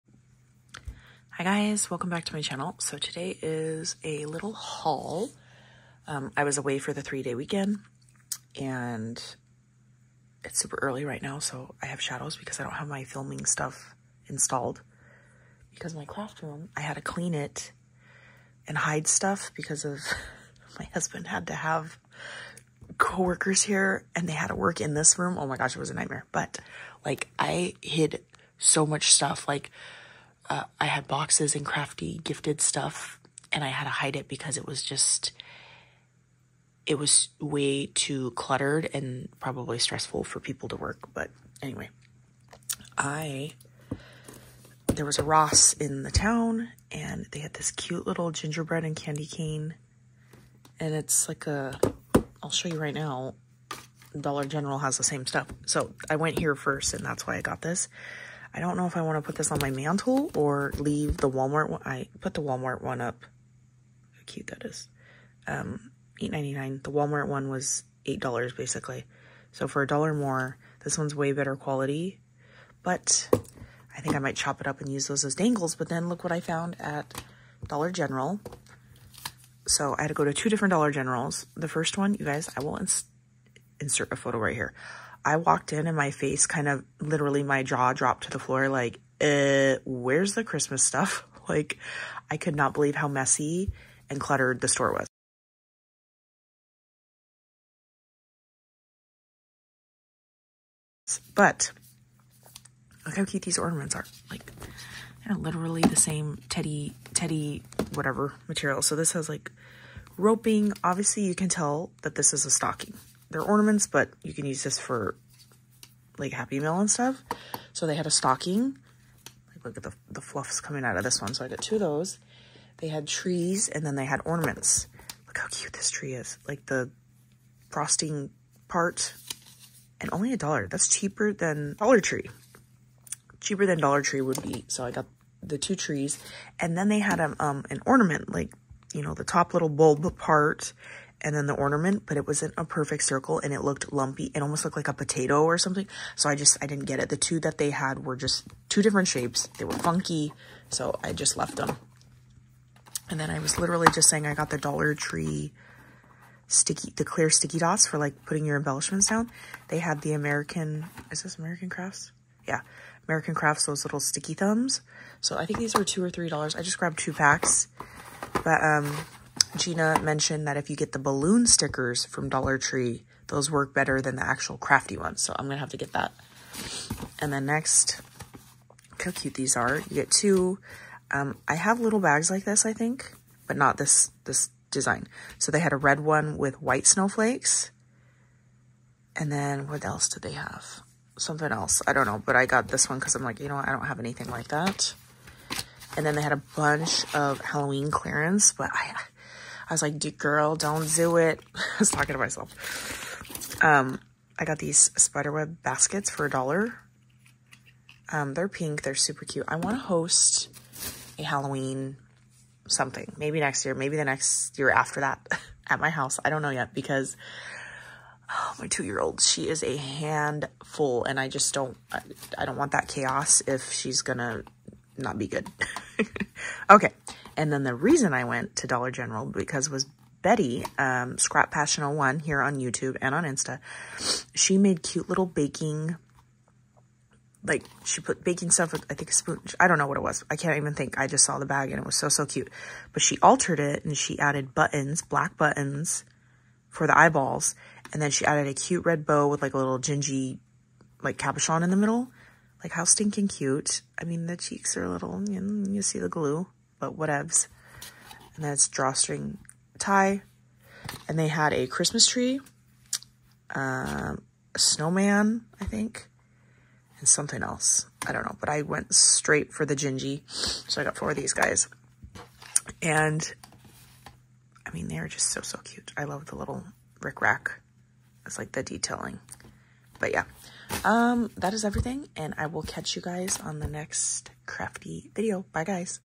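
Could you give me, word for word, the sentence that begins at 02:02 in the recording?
They had trees and then they had ornaments.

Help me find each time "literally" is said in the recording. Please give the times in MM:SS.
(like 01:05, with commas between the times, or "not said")
01:26, 01:45, 02:33.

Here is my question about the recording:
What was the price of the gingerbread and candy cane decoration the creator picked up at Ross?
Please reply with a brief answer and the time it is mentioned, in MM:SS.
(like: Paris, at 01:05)
$8.99, at 01:06.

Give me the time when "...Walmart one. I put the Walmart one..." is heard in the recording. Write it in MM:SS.
01:01.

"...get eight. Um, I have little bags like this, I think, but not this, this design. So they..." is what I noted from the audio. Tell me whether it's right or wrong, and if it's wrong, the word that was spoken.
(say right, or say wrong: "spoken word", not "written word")
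wrong: "two", not "eight".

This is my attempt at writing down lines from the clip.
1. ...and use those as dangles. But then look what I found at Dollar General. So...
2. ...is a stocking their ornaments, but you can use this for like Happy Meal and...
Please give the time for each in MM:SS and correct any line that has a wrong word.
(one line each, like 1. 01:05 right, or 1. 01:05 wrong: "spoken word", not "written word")
1. 01:14 right
2. 01:52 right.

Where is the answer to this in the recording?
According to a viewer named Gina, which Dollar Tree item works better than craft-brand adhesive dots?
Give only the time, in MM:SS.
02:50.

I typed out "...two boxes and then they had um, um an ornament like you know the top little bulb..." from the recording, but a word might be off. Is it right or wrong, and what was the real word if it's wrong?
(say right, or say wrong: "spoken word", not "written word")
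wrong: "trees", not "boxes".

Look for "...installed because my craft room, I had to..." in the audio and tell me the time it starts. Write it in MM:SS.
00:14.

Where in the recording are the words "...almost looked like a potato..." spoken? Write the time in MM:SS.
02:24.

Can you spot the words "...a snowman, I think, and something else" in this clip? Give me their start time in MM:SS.
04:24.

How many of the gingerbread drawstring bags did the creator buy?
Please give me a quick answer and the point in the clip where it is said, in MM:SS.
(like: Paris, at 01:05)
4, at 04:30.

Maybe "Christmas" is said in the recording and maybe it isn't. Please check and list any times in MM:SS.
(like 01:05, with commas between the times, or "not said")
01:30, 04:21.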